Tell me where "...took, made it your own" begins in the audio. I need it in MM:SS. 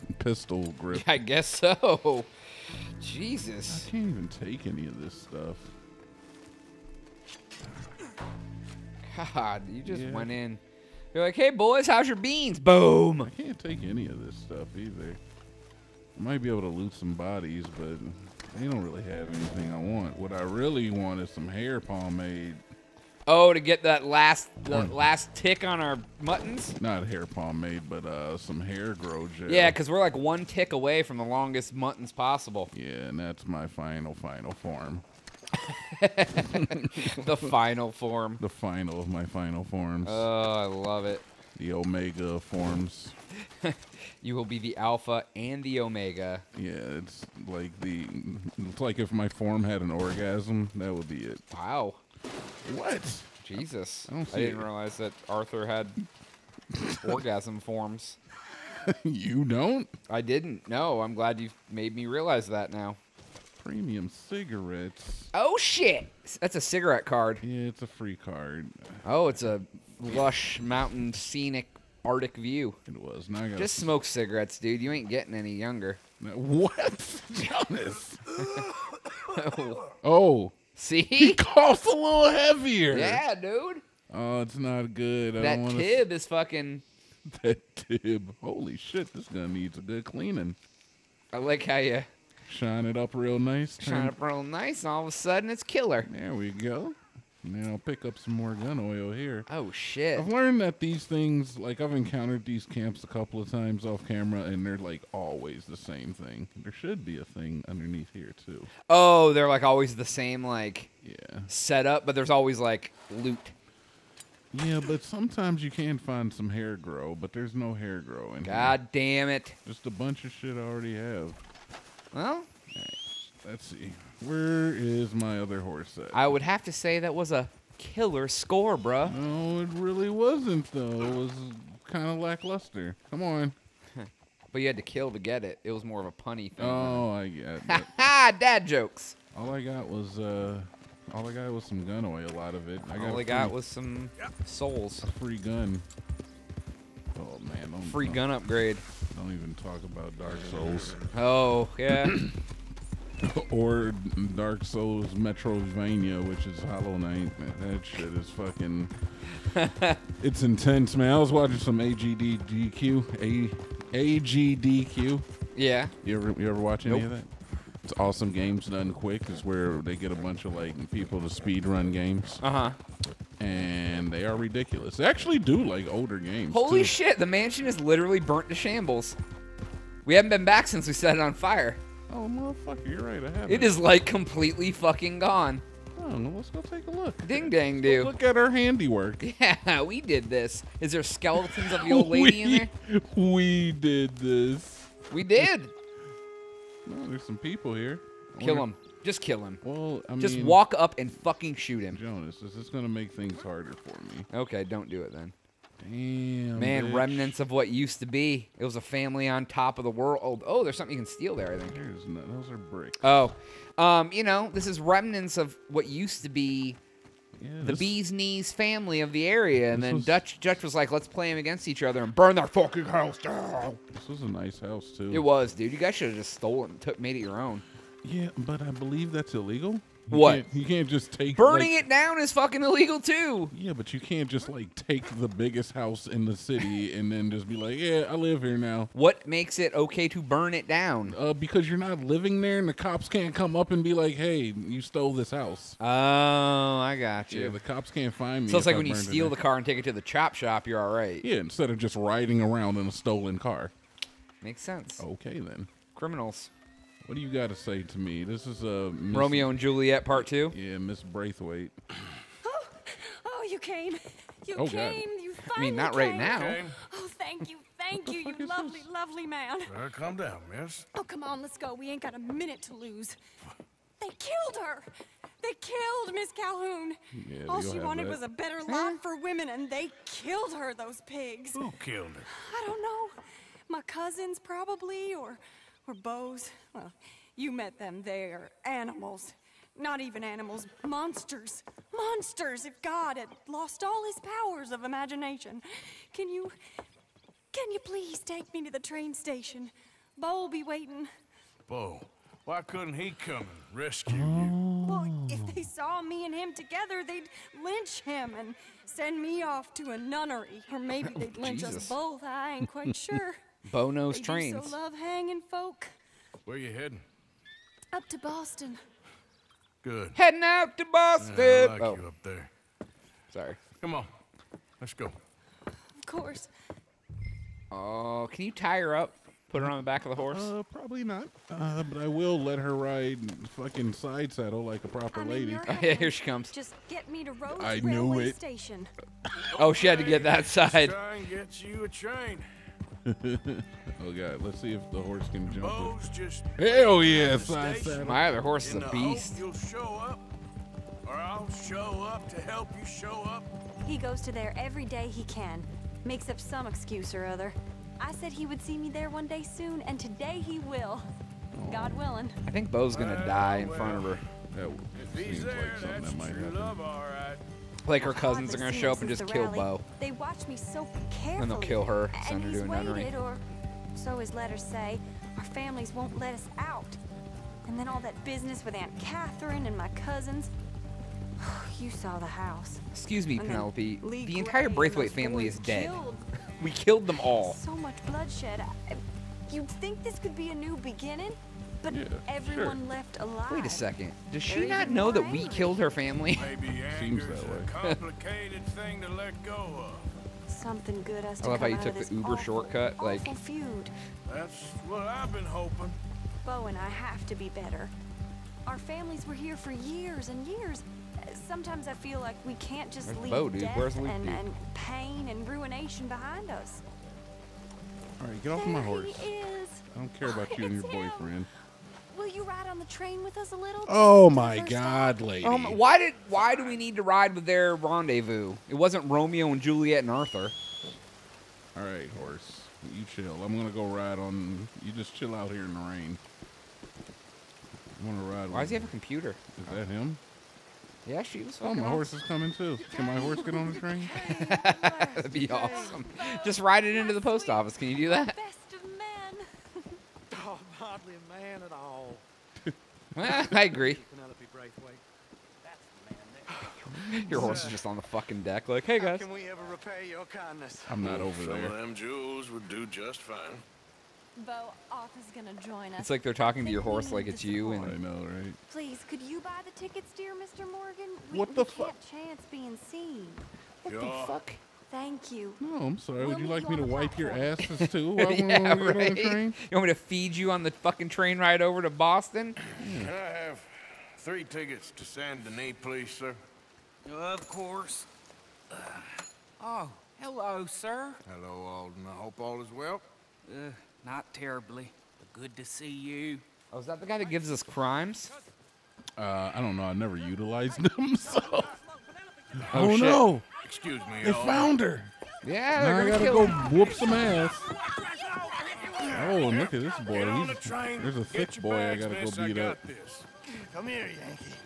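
03:46.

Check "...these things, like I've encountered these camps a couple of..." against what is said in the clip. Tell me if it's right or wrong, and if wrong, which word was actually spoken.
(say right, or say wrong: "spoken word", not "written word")
right.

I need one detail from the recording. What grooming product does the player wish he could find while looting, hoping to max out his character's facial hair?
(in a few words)
Hair grow gel.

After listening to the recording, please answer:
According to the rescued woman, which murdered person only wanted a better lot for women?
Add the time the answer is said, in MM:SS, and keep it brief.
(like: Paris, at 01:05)
Miss Calhoun, at 04:36.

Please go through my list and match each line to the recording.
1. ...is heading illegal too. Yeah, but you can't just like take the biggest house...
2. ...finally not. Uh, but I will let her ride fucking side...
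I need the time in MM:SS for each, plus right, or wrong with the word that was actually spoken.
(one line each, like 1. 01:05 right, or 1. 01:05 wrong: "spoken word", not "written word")
1. 03:52 wrong: "fucking", not "heading"
2. 05:30 wrong: "probably", not "finally".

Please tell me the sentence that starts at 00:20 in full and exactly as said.
What I really want is some hair pomade.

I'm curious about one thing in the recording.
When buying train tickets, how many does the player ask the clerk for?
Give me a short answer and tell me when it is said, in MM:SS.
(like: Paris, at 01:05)
3, at 08:04.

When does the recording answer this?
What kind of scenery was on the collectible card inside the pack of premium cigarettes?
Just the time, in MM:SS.
01:12.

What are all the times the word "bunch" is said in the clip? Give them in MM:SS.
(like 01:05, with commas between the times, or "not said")
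01:59, 02:50.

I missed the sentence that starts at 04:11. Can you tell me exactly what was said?
Yeah, instead of just riding around in a stolen car.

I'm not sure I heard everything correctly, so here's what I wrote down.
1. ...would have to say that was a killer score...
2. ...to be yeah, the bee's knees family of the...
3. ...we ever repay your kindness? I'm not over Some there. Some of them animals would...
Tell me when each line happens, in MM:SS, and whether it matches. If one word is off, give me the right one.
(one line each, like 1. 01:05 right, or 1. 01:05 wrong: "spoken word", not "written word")
1. 02:06 right
2. 03:36 right
3. 07:39 wrong: "jewels", not "animals".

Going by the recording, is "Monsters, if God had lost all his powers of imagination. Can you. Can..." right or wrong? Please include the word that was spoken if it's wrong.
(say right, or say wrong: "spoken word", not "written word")
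right.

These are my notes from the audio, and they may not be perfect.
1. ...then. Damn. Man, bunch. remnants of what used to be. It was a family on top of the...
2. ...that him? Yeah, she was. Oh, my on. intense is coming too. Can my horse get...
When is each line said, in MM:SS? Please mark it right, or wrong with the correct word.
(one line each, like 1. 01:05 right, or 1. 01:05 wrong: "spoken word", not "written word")
1. 03:25 wrong: "bitch", not "bunch"
2. 07:19 wrong: "horse", not "intense".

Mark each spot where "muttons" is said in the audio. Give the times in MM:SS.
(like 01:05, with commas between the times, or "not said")
00:26, 00:31.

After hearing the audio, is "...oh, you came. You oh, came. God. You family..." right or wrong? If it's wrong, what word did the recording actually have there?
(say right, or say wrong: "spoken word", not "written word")
wrong: "finally", not "family".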